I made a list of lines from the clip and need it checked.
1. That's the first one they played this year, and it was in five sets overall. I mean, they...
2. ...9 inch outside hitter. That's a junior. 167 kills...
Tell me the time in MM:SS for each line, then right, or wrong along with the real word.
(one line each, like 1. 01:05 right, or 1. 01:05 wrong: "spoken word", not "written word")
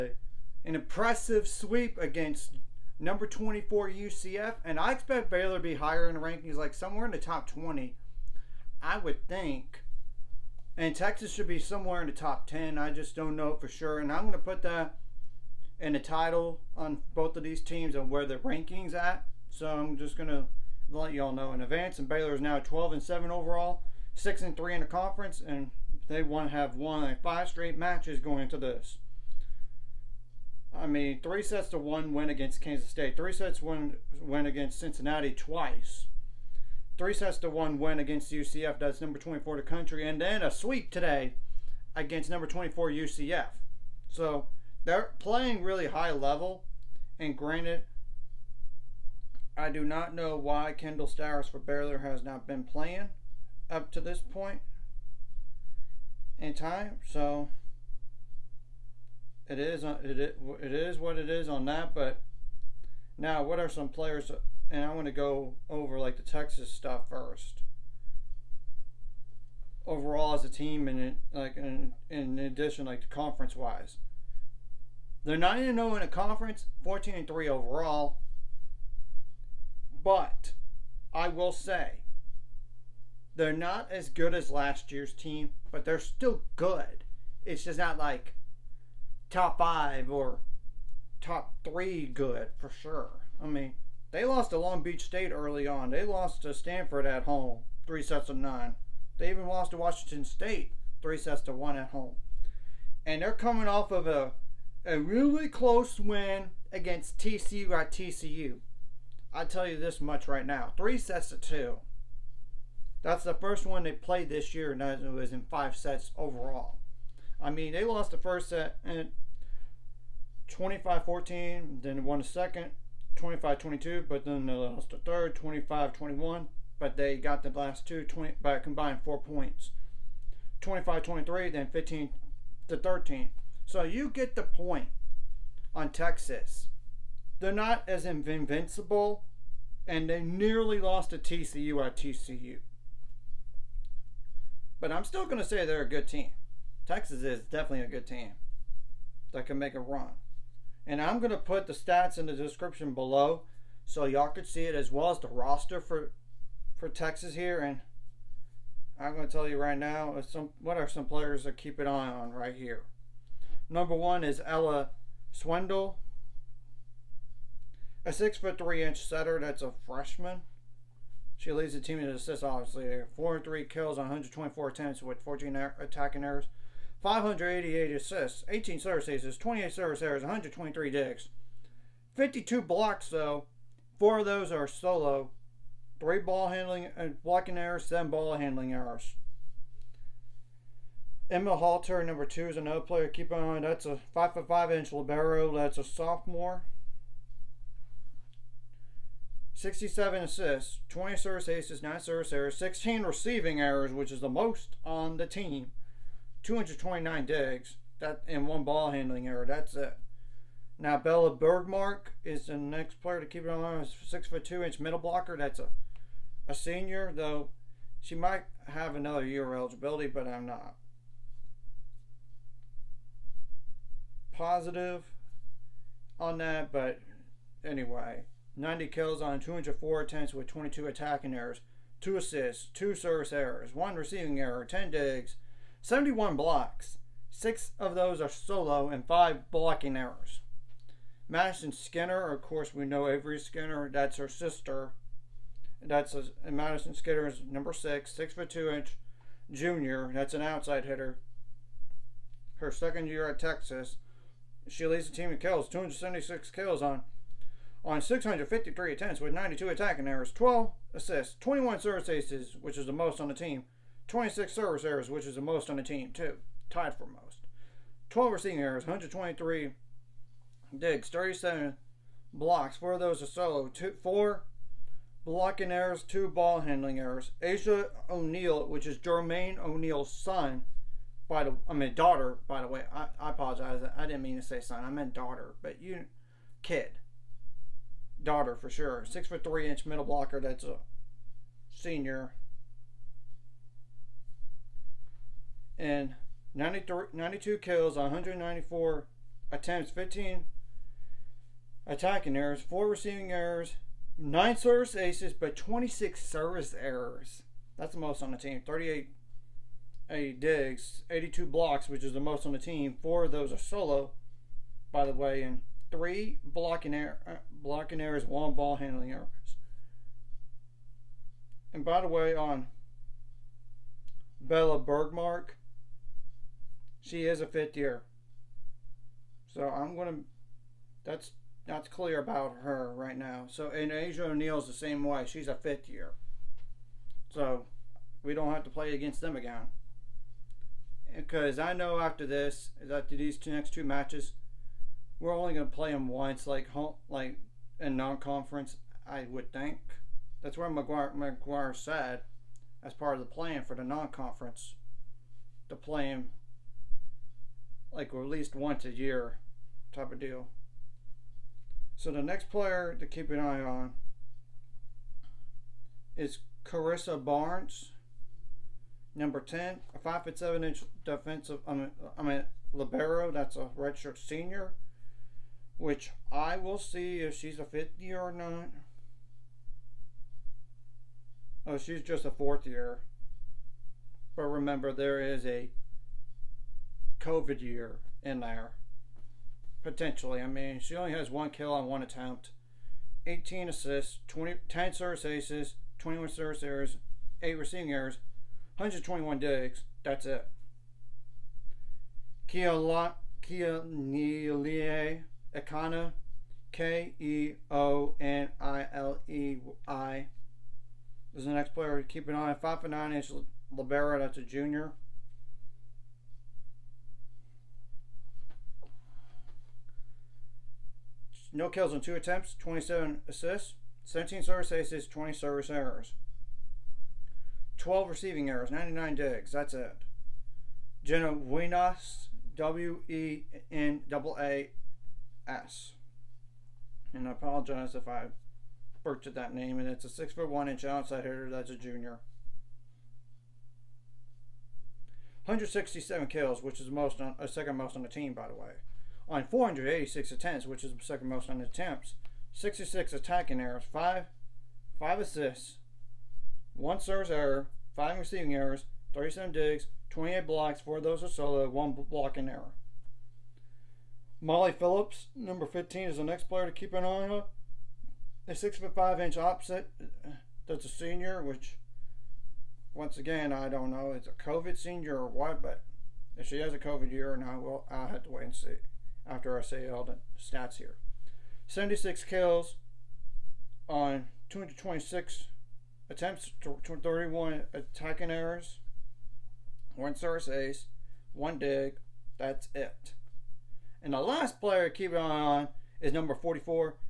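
1. 01:53 right
2. 07:20 wrong: "1", not "9".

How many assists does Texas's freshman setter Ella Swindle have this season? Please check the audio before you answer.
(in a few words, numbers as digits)
588.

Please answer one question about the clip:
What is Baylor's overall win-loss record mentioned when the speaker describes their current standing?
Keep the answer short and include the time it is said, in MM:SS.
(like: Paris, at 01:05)
12-7, at 00:22.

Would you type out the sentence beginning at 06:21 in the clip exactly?
Oh, she's just a fourth year.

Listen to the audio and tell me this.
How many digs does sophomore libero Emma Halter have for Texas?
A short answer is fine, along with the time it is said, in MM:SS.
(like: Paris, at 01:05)
229, at 03:26.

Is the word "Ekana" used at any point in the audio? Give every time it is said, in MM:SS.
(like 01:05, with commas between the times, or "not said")
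06:45.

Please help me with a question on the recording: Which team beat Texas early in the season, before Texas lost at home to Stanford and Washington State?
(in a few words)
Long Beach State.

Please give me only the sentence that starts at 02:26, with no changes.
Texas is definitely a good team that can make a run.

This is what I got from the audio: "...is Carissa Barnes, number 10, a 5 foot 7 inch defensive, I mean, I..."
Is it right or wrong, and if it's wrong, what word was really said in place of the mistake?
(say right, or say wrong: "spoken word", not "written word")
right.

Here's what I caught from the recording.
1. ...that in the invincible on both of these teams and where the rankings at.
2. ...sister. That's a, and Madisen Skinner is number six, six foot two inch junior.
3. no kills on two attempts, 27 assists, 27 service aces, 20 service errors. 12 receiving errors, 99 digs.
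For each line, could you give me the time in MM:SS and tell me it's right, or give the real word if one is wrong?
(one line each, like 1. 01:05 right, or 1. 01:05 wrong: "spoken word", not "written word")
1. 00:14 wrong: "title", not "invincible"
2. 04:04 right
3. 07:01 wrong: "17", not "27".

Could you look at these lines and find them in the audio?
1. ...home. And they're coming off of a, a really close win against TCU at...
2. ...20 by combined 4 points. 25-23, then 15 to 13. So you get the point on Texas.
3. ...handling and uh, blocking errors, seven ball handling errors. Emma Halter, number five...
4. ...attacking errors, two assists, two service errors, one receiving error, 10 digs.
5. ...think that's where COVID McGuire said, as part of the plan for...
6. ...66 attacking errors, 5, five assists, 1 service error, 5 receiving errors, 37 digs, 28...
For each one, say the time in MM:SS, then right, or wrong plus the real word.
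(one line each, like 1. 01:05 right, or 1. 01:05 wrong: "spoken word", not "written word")
1. 01:41 right
2. 02:08 right
3. 03:06 wrong: "two", not "five"
4. 03:50 right
5. 05:49 wrong: "McGuire", not "COVID"
6. 07:32 right.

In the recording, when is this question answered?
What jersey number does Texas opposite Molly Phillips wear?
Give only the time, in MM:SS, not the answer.
07:45.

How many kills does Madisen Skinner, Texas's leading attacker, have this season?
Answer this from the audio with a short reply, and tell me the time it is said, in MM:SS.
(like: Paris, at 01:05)
276, at 04:15.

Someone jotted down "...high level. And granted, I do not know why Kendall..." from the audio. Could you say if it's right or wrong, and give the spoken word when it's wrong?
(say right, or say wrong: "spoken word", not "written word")
right.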